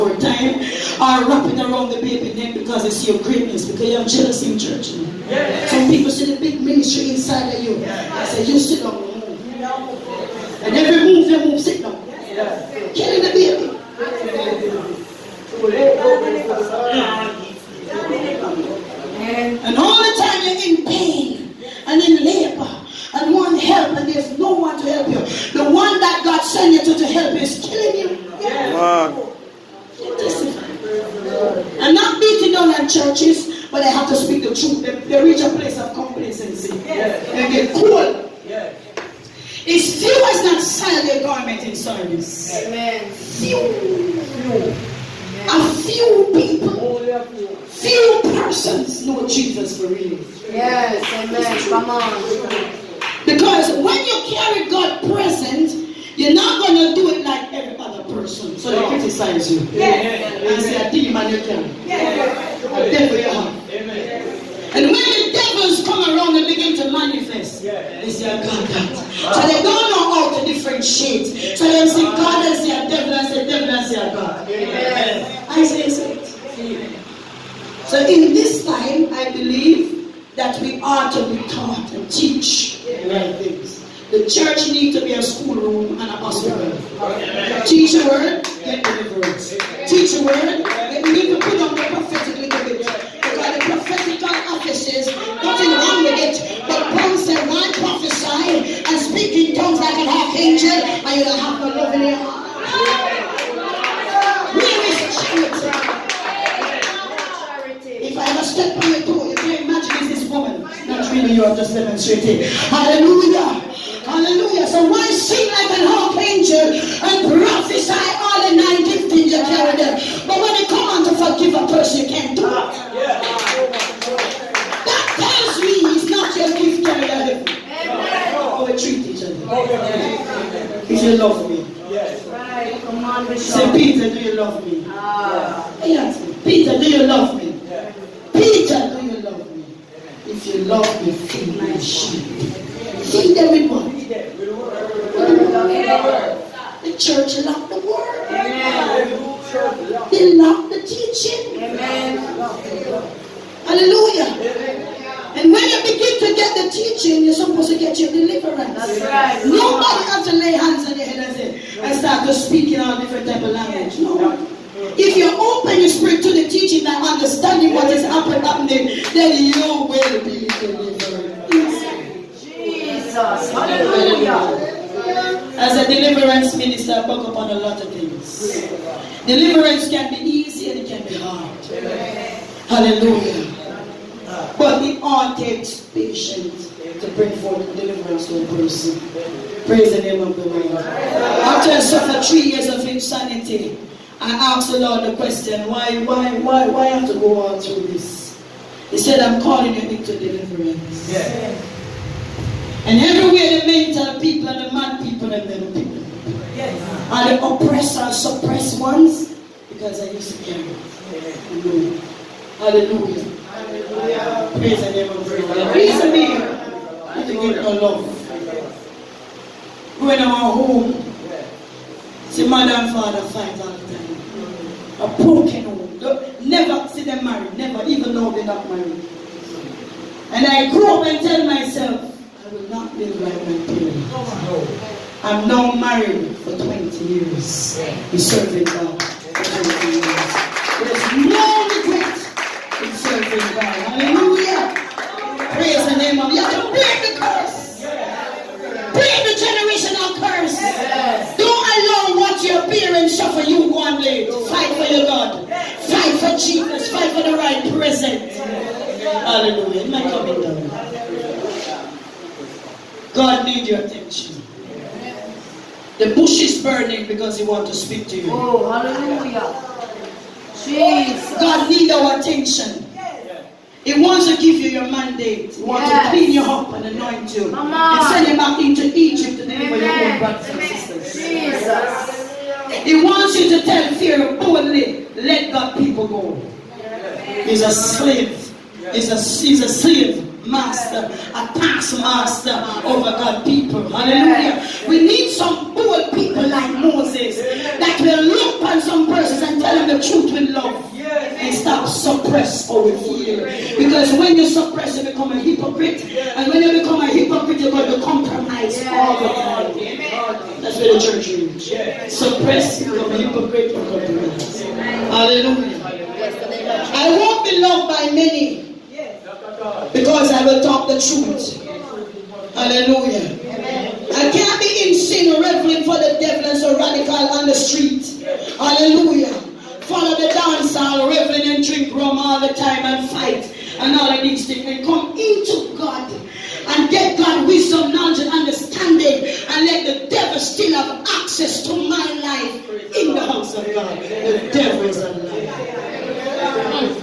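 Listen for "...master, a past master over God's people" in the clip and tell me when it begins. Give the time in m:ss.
4:50.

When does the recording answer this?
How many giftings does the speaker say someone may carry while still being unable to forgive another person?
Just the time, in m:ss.
1:58.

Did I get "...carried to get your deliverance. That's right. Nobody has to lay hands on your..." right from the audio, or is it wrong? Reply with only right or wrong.
wrong.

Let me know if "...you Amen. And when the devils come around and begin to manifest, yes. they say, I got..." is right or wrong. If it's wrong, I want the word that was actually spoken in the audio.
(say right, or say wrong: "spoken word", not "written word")
right.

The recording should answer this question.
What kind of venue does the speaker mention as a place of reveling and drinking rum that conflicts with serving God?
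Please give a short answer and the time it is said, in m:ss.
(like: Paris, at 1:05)
dance hall, at 5:30.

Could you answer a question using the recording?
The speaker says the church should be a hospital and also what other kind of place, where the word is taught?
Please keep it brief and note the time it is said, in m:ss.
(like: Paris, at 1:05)
schoolroom, at 1:25.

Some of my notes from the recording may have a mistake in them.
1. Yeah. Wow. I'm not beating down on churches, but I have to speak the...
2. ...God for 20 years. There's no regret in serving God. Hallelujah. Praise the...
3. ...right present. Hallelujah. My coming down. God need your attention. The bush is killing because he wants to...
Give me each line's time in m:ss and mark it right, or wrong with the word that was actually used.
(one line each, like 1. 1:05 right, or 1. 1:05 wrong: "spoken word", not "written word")
1. 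0:28 right
2. 3:58 right
3. 4:17 wrong: "burning", not "killing".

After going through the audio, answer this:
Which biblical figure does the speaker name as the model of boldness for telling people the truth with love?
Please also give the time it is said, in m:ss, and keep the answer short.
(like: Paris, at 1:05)
Moses, at 4:56.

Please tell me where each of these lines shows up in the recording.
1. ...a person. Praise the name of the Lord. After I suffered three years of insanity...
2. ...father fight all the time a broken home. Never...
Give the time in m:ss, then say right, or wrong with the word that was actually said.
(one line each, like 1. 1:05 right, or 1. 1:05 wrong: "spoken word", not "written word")
1. 3:08 right
2. 3:42 right.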